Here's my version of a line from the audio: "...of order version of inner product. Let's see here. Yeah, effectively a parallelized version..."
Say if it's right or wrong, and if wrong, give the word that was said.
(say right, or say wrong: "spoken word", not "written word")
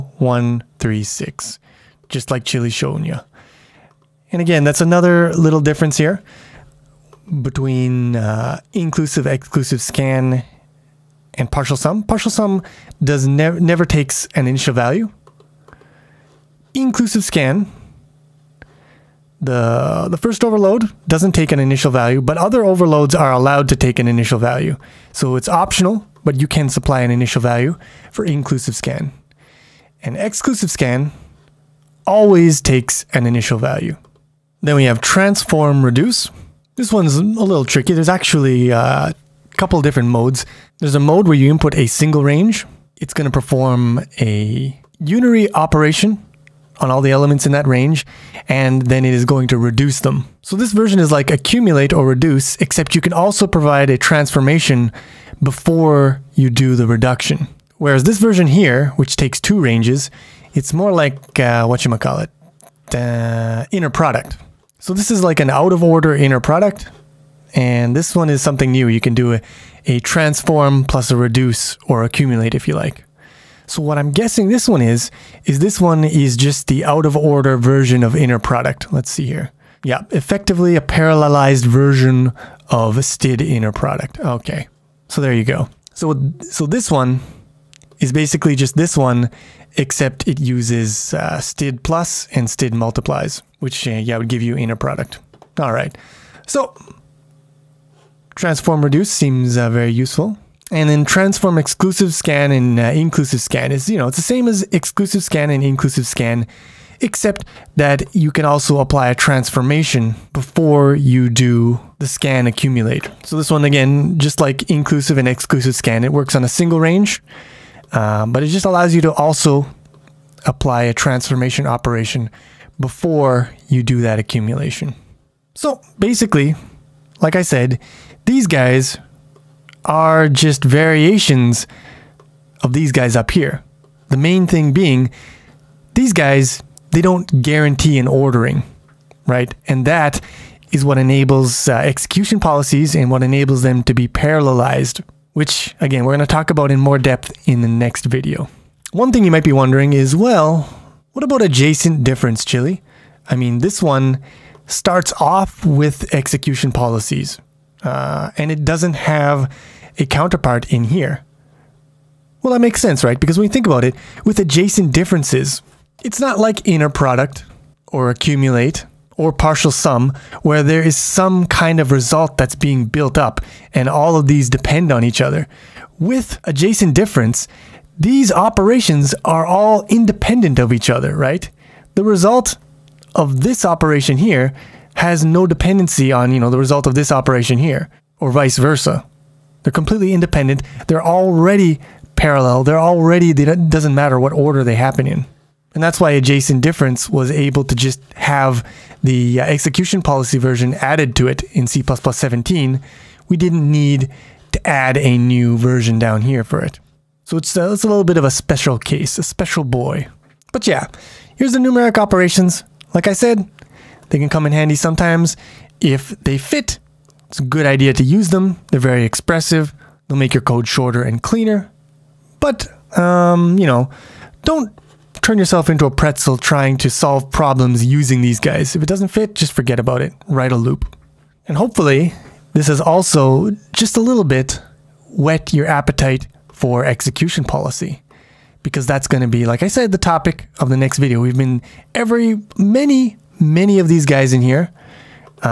right.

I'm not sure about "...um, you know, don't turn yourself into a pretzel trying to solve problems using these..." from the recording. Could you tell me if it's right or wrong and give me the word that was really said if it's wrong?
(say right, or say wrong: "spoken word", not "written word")
right.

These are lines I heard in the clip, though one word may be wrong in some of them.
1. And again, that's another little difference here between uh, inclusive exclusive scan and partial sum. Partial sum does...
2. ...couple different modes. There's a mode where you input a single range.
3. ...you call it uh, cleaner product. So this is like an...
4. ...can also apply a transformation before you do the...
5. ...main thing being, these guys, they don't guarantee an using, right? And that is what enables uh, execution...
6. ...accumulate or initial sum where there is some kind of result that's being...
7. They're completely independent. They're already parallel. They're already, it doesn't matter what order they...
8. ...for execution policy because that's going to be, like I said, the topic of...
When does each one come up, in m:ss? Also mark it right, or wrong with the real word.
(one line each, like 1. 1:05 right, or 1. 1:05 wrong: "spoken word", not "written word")
1. 0:04 right
2. 0:39 right
3. 1:01 wrong: "inner", not "cleaner"
4. 1:48 right
5. 2:14 wrong: "ordering", not "using"
6. 2:48 wrong: "partial", not "initial"
7. 3:09 right
8. 3:56 right.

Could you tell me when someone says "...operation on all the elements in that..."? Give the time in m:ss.
0:45.